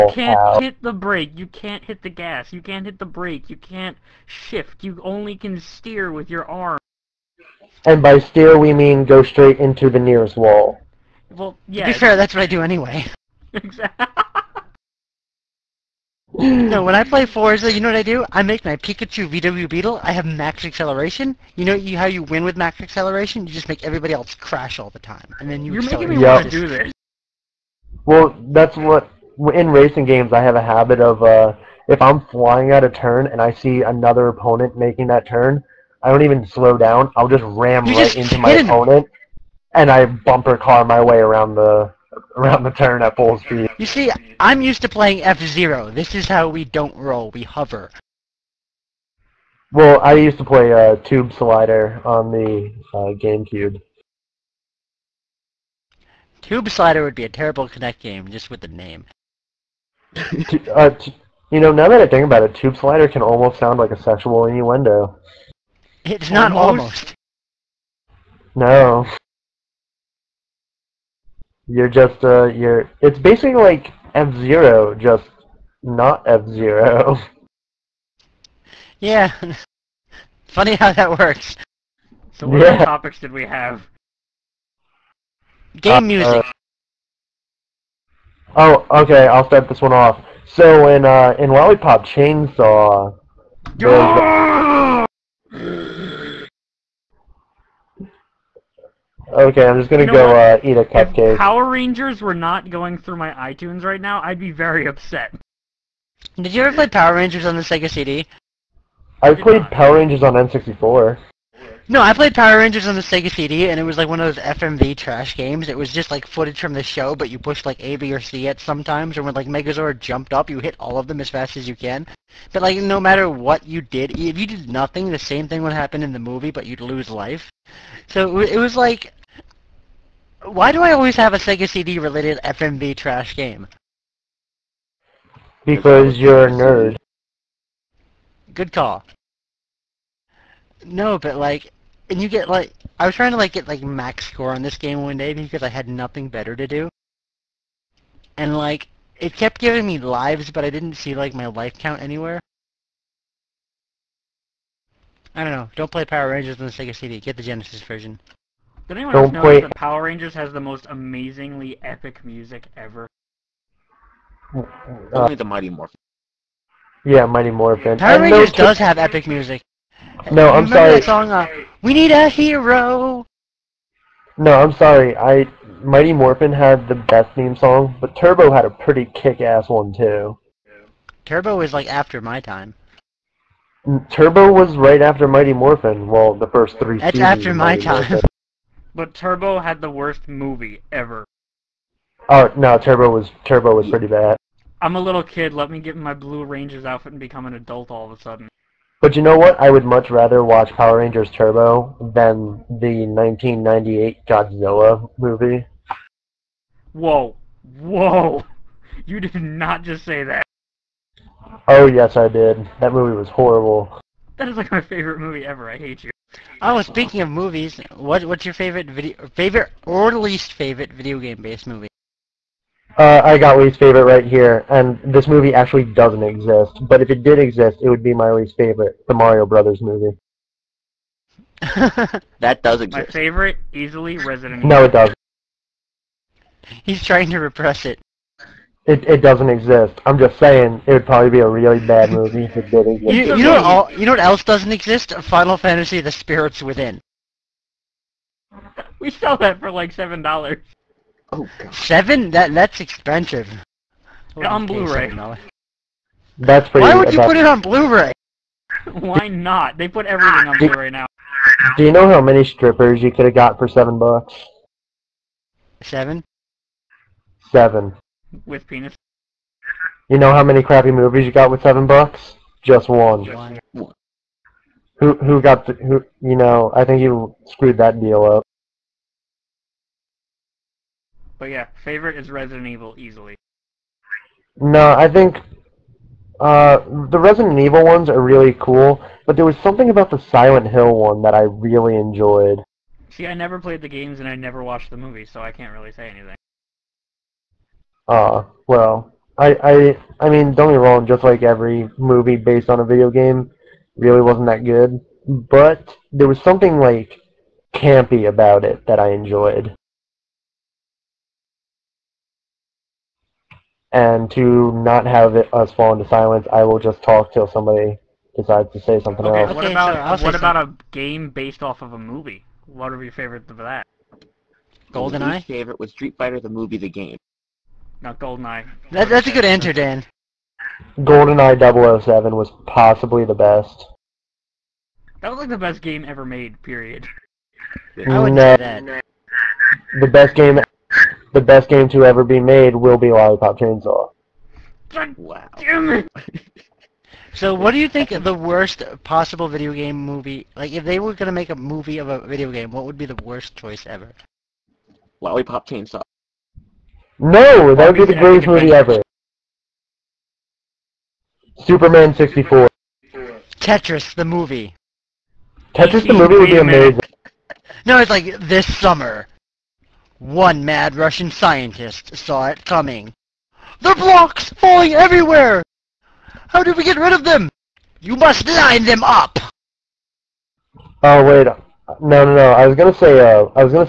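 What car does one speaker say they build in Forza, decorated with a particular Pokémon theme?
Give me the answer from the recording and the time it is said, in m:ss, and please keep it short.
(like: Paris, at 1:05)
Pikachu VW Beetle, at 0:18.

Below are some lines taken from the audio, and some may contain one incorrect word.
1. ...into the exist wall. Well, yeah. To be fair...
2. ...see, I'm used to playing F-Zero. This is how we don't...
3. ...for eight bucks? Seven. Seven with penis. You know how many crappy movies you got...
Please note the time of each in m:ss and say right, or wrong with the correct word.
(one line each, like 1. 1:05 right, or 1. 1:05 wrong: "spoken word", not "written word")
1. 0:09 wrong: "nearest", not "exist"
2. 0:43 right
3. 4:23 wrong: "seven", not "eight".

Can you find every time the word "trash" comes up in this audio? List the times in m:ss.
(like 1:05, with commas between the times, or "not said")
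1:54, 2:12.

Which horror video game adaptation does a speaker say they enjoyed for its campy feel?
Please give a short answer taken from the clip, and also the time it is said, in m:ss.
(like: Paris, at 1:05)
Silent Hill, at 4:50.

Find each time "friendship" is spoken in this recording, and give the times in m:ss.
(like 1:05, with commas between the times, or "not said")
not said.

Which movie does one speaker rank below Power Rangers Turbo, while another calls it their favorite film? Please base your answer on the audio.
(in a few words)
1998 Godzilla.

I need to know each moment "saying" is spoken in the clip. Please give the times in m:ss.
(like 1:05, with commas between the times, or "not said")
4:00.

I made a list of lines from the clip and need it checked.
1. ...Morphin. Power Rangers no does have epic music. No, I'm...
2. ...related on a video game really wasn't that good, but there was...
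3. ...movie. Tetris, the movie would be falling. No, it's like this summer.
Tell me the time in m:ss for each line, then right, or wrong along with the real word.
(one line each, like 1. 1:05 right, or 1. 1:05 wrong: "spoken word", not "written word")
1. 2:47 right
2. 5:02 wrong: "based", not "related"
3. 6:04 wrong: "amazing", not "falling".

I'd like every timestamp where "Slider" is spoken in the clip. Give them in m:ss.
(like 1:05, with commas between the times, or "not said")
0:51, 0:56, 1:02.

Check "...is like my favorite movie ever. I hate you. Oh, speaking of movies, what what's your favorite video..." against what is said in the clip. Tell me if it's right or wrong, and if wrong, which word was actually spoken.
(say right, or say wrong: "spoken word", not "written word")
right.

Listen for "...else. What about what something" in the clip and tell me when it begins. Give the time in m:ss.
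5:19.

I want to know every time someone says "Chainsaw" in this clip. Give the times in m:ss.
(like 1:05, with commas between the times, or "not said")
1:32, 5:43, 5:55.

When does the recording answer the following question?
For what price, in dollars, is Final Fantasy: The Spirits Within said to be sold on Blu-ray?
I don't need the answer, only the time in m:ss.
4:09.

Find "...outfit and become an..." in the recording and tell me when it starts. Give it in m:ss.
3:16.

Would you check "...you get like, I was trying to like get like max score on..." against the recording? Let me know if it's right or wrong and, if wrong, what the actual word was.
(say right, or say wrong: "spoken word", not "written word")
right.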